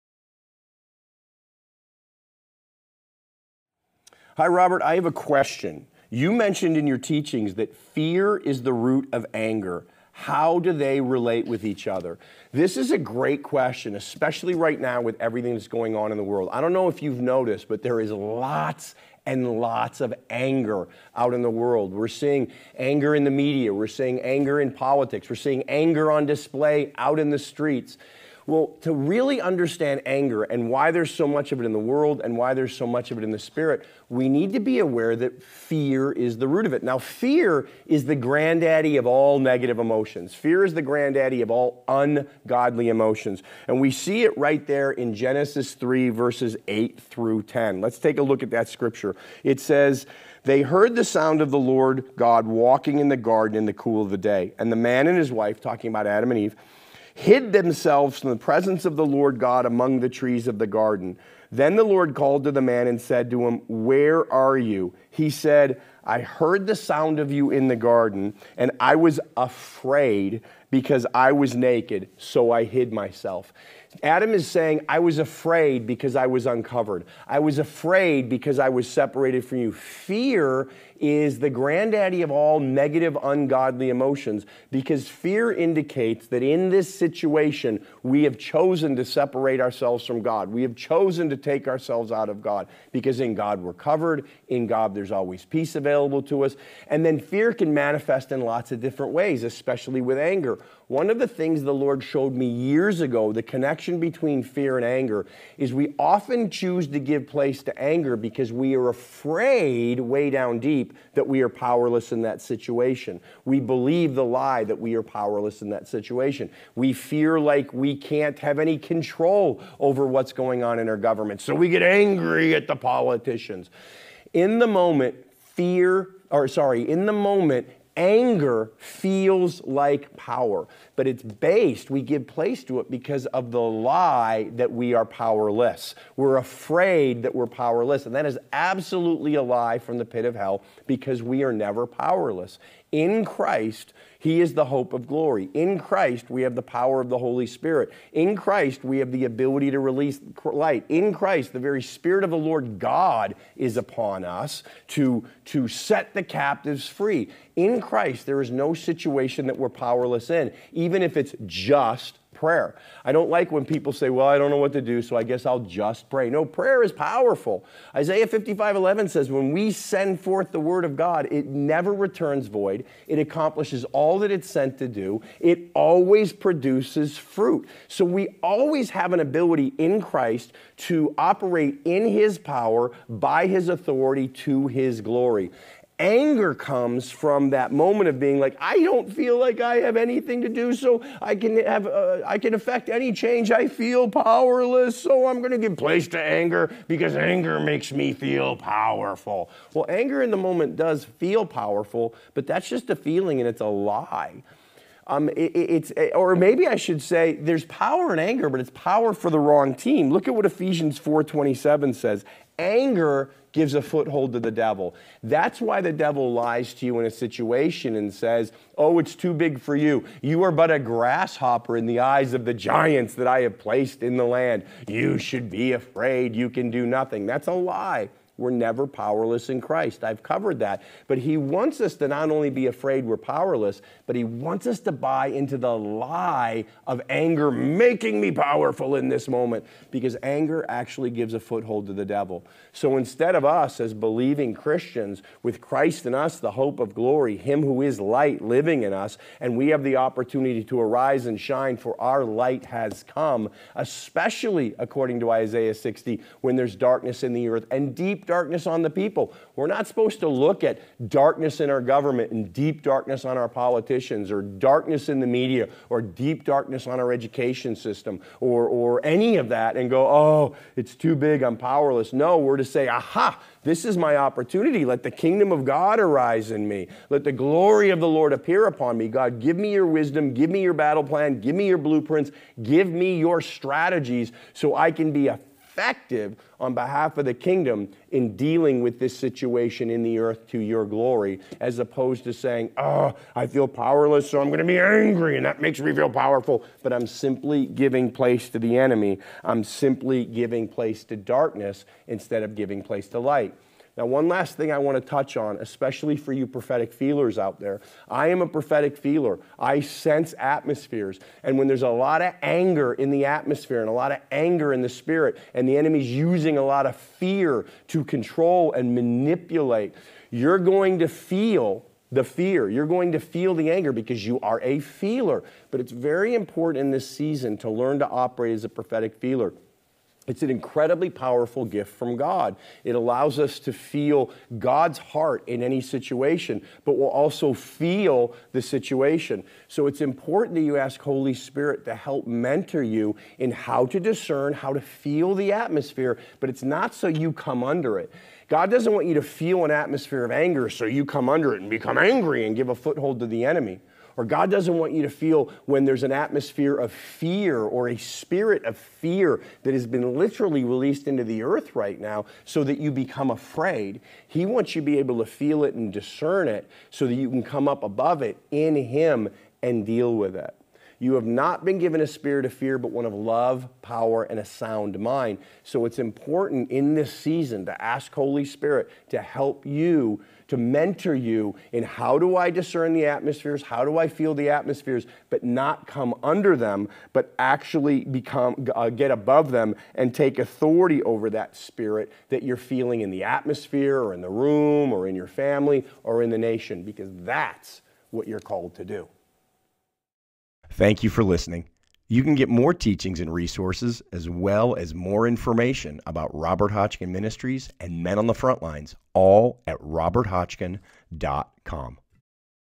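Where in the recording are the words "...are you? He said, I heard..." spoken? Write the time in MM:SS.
01:04.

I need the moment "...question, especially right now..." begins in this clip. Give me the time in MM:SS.
00:13.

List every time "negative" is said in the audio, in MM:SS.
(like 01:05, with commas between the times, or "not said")
00:39, 01:22.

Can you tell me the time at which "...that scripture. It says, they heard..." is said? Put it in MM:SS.
00:48.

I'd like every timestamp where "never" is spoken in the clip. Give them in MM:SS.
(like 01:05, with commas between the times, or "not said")
02:21, 02:51, 03:48.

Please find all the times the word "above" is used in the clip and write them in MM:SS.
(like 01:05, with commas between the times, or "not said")
06:07, 06:29.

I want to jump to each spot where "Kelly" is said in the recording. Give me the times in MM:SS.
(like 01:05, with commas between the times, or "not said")
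not said.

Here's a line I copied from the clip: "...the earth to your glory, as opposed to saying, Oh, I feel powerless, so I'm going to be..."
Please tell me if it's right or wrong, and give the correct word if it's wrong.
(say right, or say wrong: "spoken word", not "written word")
right.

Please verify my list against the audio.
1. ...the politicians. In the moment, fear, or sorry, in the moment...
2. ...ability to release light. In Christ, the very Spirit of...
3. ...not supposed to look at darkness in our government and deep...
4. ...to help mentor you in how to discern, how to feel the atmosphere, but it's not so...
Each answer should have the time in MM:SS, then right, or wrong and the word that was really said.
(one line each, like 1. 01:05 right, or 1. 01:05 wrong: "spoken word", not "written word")
1. 02:02 right
2. 02:29 right
3. 04:19 right
4. 05:41 right.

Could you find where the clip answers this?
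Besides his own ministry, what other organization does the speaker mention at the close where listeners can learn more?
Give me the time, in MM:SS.
06:48.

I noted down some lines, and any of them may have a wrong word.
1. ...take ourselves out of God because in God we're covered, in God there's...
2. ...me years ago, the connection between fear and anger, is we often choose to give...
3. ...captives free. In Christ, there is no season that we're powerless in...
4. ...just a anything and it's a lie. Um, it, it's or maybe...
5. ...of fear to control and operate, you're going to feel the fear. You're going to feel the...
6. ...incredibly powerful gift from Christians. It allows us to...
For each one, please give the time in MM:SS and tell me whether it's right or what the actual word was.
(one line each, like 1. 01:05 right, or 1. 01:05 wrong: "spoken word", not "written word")
1. 01:31 right
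2. 01:42 right
3. 02:36 wrong: "situation", not "season"
4. 03:22 wrong: "feeling", not "anything"
5. 05:16 wrong: "manipulate", not "operate"
6. 05:30 wrong: "God", not "Christians".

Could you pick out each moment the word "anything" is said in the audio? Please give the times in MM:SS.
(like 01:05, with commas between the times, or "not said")
03:09.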